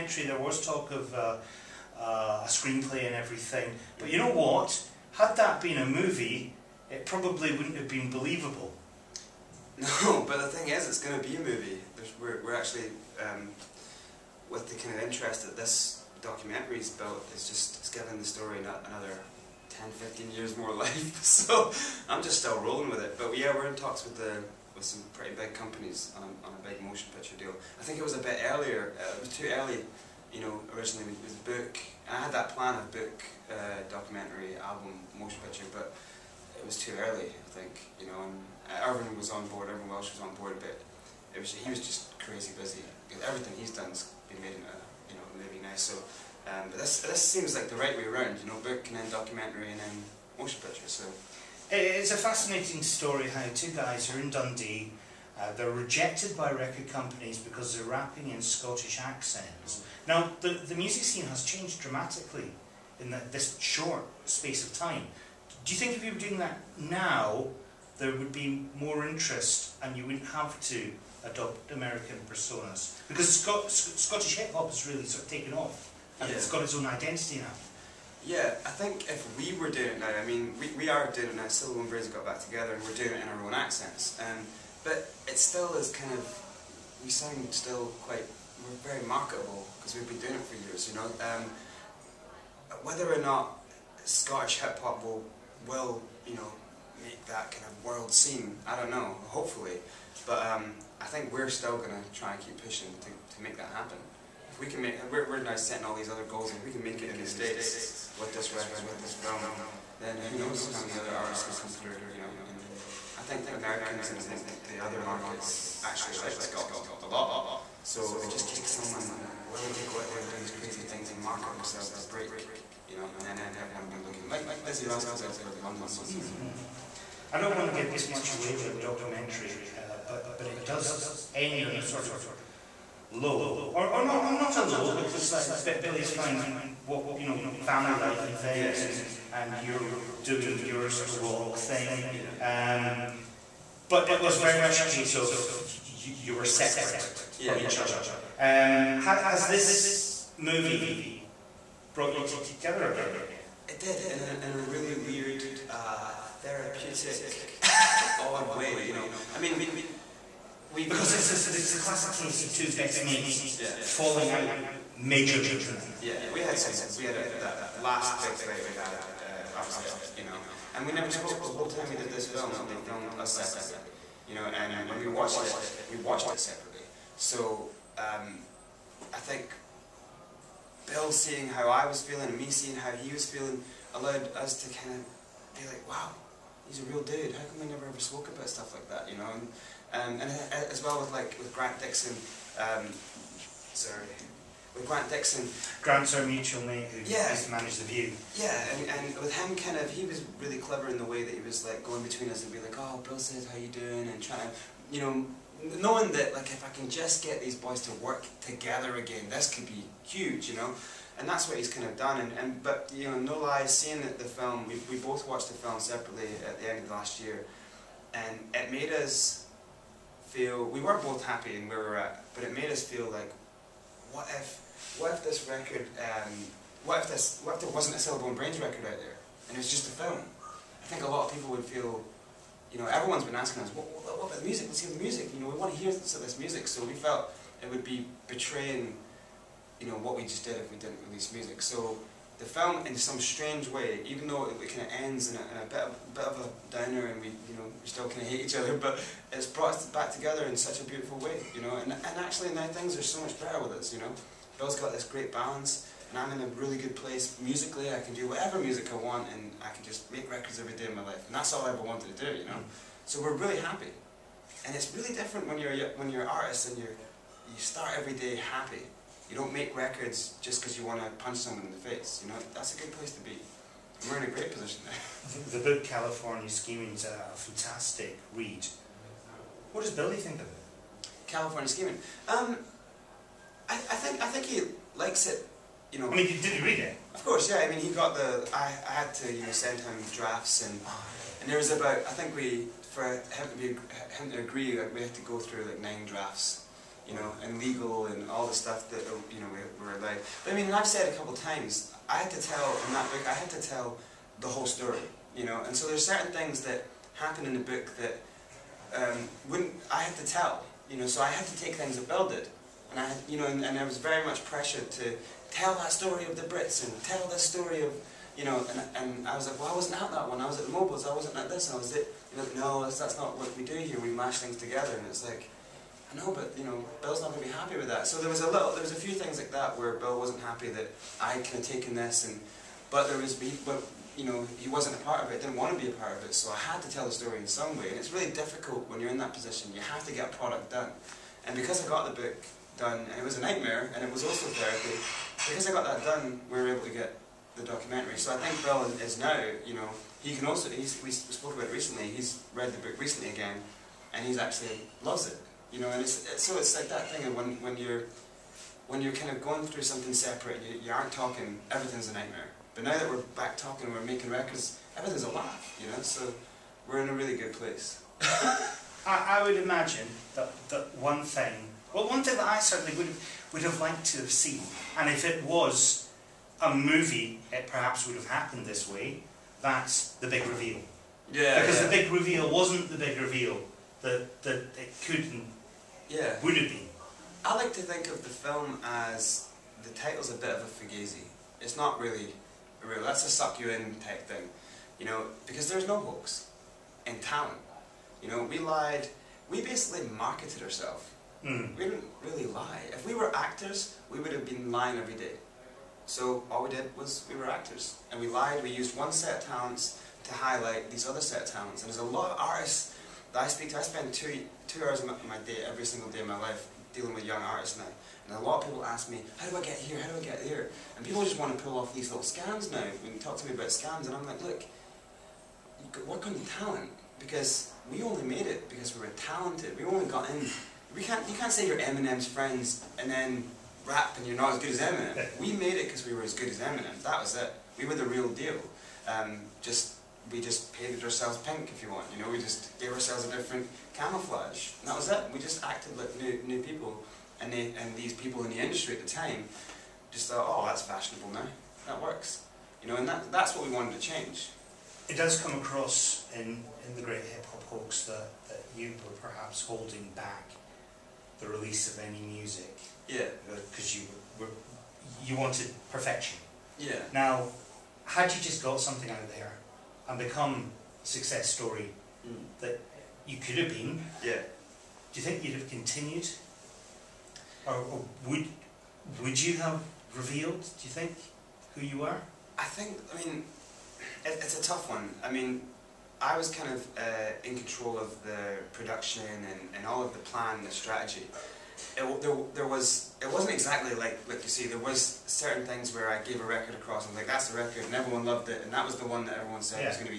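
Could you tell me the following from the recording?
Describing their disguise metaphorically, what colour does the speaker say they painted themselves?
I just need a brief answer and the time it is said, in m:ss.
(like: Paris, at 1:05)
pink, at 7:21.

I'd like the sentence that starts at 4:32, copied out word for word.
You know, that's a good place to be.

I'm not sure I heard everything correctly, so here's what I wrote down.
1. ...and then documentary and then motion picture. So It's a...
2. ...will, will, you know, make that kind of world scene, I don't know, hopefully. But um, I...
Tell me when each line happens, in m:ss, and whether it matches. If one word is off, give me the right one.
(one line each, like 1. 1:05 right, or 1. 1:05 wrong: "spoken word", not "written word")
1. 0:48 right
2. 1:35 right.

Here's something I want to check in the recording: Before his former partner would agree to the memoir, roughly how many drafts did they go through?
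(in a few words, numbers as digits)
9.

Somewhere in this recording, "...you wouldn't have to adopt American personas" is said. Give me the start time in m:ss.
1:09.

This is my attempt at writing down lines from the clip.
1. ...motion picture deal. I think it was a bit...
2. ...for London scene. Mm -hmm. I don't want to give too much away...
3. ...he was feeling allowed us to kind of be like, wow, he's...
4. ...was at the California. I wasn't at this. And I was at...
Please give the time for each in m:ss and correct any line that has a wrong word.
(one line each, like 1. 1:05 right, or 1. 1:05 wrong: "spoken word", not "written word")
1. 0:26 right
2. 2:05 right
3. 3:02 right
4. 5:20 wrong: "MOBOs", not "California".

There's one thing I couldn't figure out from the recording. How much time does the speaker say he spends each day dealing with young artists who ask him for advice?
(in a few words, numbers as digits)
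2 hours.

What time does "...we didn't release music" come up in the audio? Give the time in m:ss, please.
4:00.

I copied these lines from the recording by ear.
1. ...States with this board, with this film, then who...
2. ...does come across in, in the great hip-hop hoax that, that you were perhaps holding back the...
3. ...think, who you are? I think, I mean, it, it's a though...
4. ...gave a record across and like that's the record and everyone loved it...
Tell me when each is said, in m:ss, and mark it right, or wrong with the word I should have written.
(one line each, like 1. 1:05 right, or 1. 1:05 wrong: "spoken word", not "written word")
1. 1:47 wrong: "record", not "board"
2. 7:35 right
3. 8:00 wrong: "tough", not "though"
4. 8:16 right.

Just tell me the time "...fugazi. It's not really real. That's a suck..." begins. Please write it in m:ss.
6:30.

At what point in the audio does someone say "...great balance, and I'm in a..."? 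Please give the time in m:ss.
4:15.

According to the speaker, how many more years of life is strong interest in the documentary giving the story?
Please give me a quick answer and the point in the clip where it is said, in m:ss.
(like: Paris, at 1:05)
10, 15 years, at 0:19.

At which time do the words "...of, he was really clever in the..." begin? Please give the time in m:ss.
3:19.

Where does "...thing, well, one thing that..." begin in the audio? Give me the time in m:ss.
6:11.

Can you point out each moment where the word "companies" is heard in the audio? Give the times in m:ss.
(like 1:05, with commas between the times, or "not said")
0:25, 0:56.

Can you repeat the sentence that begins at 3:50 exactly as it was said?
I think a lot of people would feel.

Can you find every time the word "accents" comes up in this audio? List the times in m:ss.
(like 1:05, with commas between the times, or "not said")
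0:58, 1:23.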